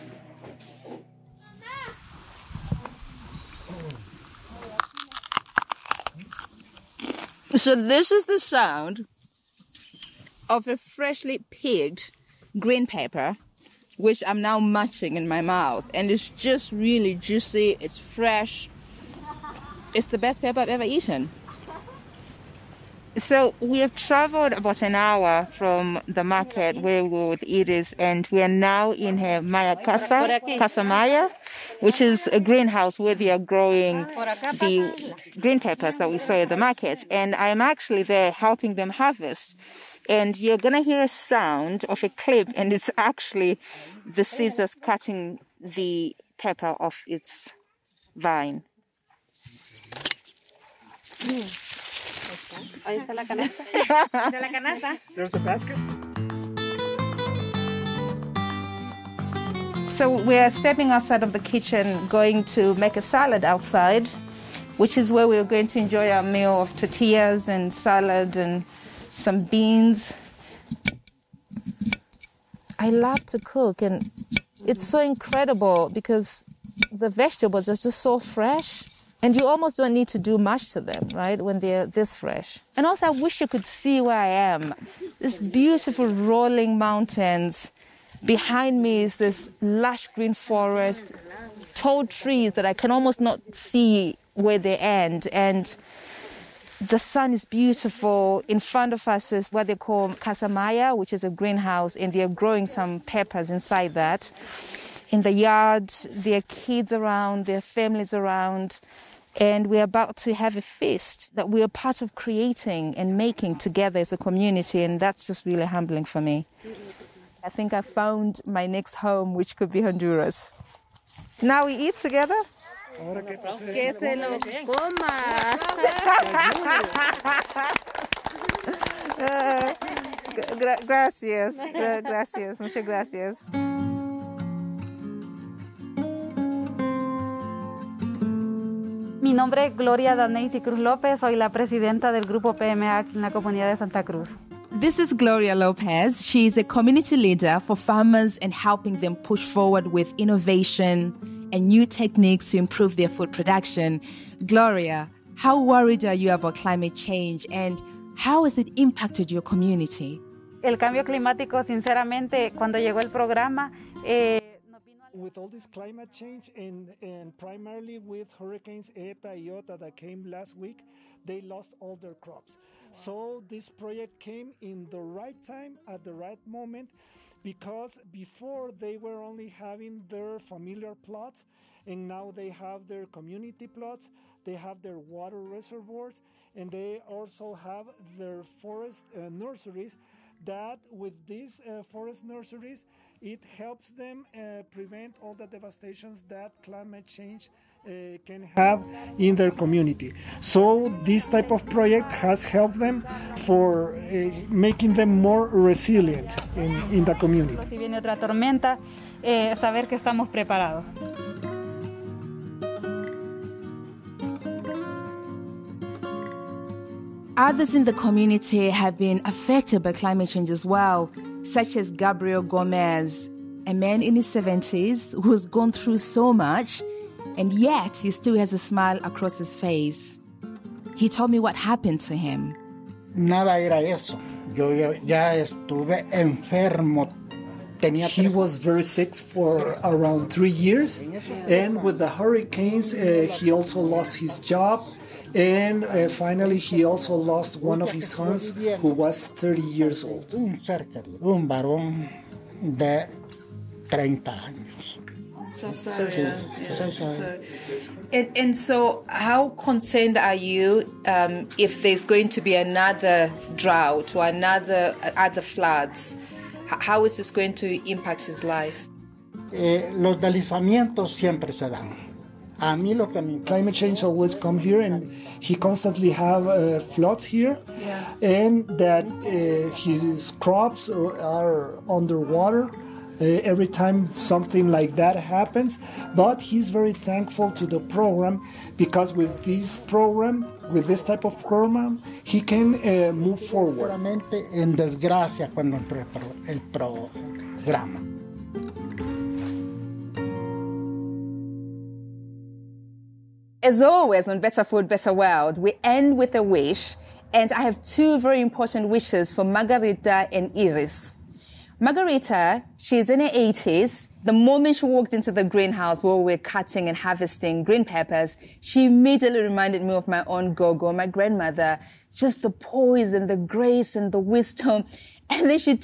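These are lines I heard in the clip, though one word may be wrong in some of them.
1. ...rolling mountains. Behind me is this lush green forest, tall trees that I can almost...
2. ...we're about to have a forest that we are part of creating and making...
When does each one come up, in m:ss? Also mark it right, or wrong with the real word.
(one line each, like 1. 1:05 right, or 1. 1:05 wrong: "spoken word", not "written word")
1. 1:26 right
2. 1:49 wrong: "feast", not "forest".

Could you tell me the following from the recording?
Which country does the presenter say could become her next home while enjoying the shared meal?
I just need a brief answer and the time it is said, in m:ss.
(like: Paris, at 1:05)
Honduras, at 1:59.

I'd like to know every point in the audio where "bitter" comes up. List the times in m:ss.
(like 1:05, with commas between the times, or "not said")
not said.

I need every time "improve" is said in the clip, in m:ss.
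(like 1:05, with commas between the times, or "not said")
2:32.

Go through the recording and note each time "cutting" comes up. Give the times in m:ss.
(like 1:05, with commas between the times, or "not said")
0:44, 5:16.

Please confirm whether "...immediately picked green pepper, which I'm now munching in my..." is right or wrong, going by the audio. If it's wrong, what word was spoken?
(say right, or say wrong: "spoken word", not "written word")
wrong: "freshly", not "immediately".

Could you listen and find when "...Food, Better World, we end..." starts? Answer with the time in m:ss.
5:04.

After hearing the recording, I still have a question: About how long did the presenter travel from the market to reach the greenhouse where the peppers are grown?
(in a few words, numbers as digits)
About an hour.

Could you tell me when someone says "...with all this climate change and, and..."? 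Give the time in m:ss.
2:45.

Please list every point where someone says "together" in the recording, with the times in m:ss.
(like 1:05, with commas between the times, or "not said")
1:53, 2:01.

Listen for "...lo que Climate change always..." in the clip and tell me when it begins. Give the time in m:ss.
4:32.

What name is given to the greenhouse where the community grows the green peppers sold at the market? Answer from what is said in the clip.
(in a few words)
Casa Maya.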